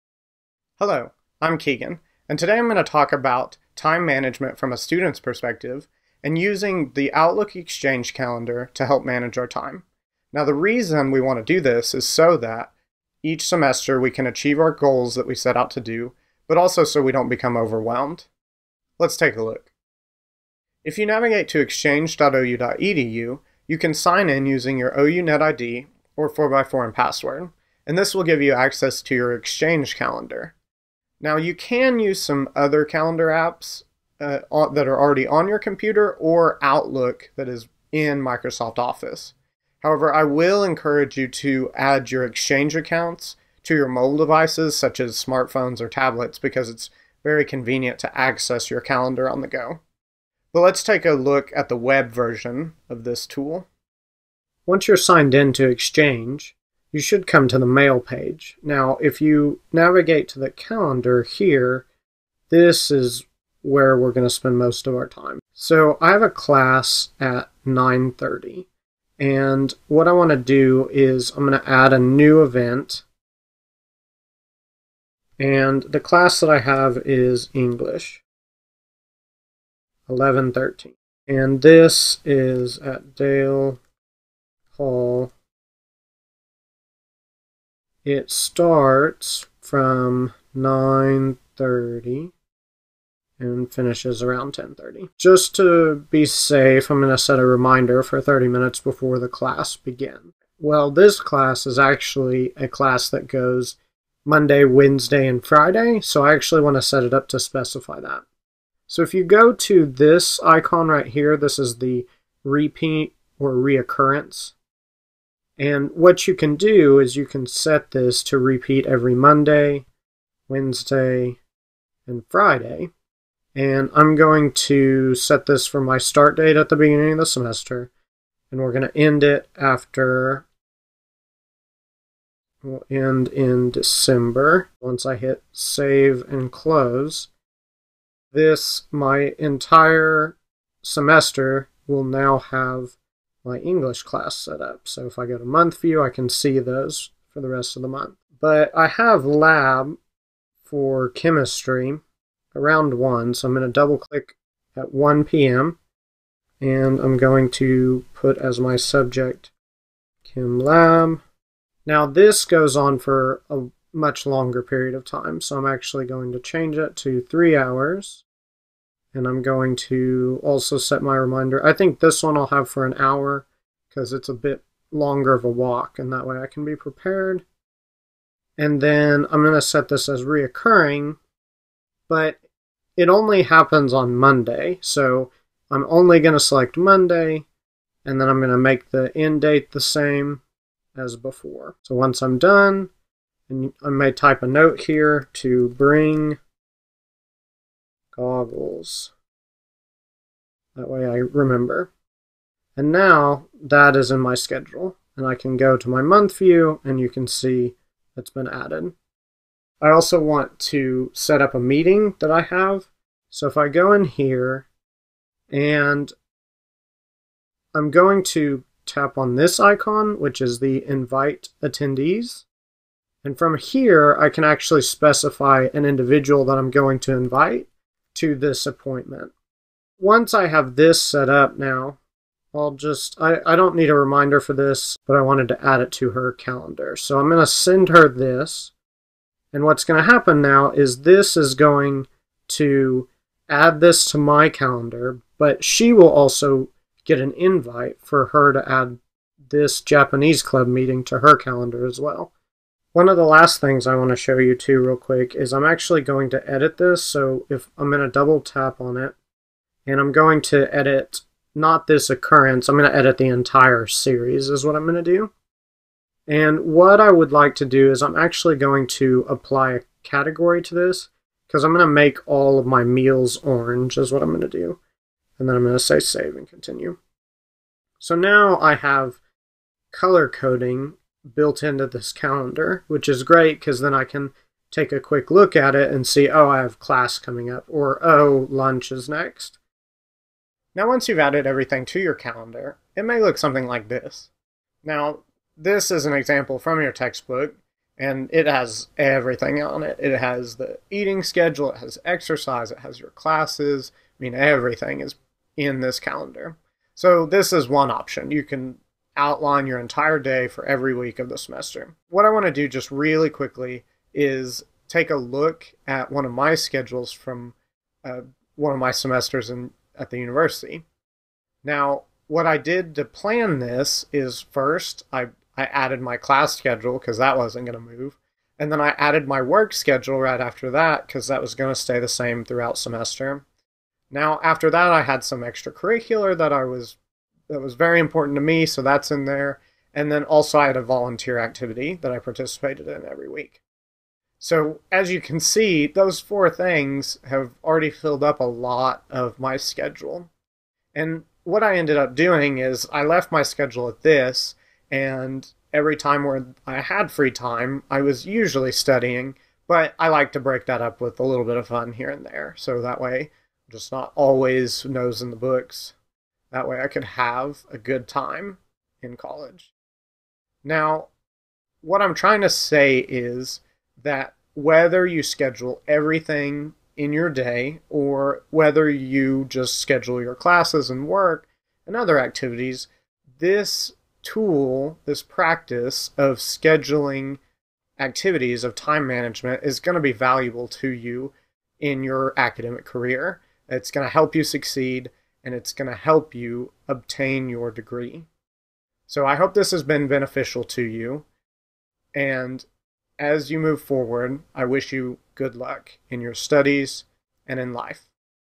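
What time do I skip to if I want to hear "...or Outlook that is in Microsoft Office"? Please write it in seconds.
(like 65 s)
36 s.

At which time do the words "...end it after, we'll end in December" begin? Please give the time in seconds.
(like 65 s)
128 s.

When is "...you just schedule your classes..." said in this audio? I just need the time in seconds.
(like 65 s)
378 s.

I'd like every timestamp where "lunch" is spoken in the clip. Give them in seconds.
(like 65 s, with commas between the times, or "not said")
288 s.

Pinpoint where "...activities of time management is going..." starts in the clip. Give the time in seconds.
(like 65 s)
387 s.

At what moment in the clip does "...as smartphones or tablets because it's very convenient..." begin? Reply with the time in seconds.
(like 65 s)
44 s.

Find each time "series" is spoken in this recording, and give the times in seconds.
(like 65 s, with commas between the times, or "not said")
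263 s.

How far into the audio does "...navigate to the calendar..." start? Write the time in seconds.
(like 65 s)
59 s.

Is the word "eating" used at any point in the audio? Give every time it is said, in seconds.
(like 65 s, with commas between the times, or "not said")
300 s.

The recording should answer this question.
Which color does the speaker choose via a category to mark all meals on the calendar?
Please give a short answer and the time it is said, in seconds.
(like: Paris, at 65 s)
orange, at 273 s.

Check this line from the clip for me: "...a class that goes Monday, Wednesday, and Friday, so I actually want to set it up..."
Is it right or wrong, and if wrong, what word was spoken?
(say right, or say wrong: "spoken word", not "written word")
right.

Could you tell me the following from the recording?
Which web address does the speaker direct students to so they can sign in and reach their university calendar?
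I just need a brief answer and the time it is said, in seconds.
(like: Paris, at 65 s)
exchange.ou.edu, at 21 s.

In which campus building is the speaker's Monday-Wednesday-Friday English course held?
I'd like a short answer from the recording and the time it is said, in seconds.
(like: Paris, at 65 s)
Dale Hall, at 83 s.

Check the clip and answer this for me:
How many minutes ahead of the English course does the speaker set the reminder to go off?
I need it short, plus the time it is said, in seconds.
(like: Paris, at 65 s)
30, at 98 s.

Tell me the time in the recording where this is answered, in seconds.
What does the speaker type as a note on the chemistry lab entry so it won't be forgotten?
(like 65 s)
195 s.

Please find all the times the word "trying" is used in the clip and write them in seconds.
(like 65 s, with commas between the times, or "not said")
372 s.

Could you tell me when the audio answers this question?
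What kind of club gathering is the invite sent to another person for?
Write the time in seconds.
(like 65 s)
249 s.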